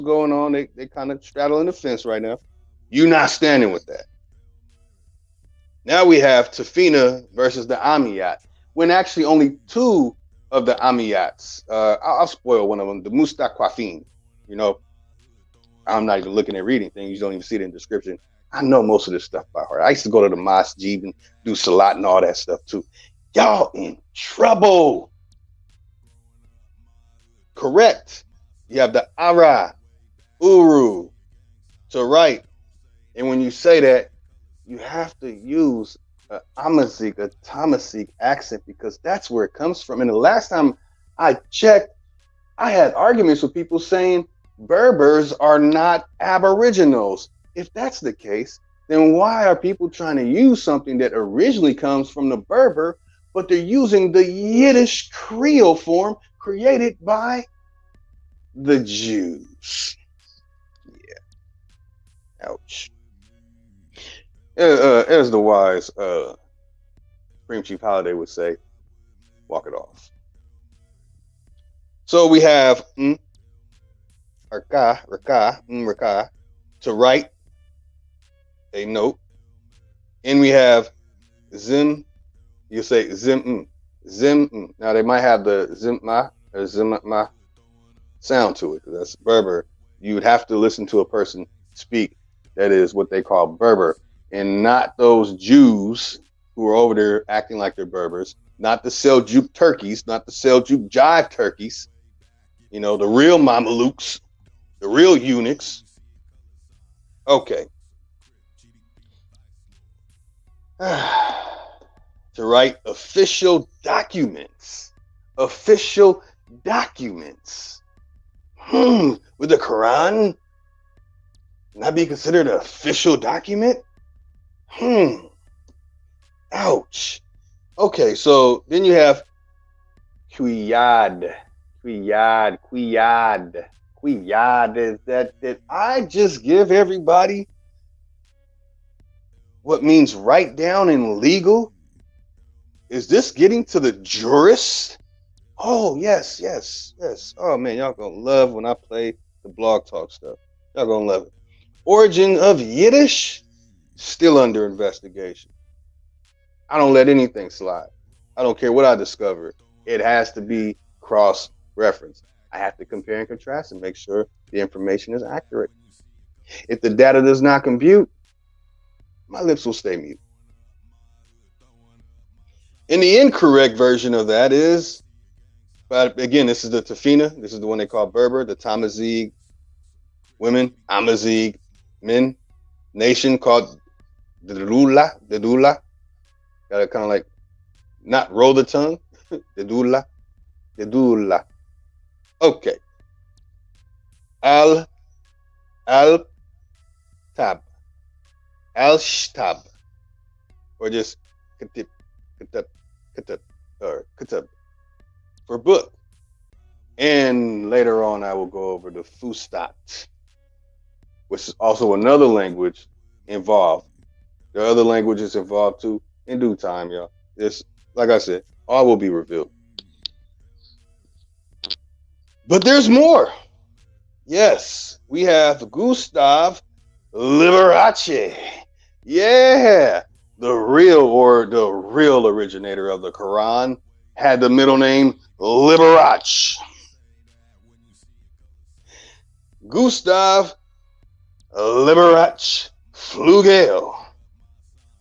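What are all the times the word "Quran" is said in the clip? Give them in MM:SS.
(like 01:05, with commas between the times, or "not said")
01:59, 03:53.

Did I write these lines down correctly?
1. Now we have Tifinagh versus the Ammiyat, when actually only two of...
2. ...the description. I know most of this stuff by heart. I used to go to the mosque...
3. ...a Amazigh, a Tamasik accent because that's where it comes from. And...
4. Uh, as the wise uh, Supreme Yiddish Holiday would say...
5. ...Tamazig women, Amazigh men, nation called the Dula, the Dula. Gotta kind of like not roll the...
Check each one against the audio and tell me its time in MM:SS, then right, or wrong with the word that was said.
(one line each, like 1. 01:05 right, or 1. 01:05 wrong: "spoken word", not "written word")
1. 00:05 right
2. 00:17 right
3. 00:36 right
4. 01:04 wrong: "Chief", not "Yiddish"
5. 02:58 right.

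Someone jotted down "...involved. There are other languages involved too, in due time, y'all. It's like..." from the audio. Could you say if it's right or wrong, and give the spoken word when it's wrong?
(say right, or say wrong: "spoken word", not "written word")
right.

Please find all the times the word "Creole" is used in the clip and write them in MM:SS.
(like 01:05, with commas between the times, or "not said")
00:55.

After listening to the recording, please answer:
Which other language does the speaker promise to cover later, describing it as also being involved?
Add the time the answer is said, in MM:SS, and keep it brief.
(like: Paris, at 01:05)
Fustat, at 03:29.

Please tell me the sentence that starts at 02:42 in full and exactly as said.
I have to compare and contrast and make sure the information is accurate.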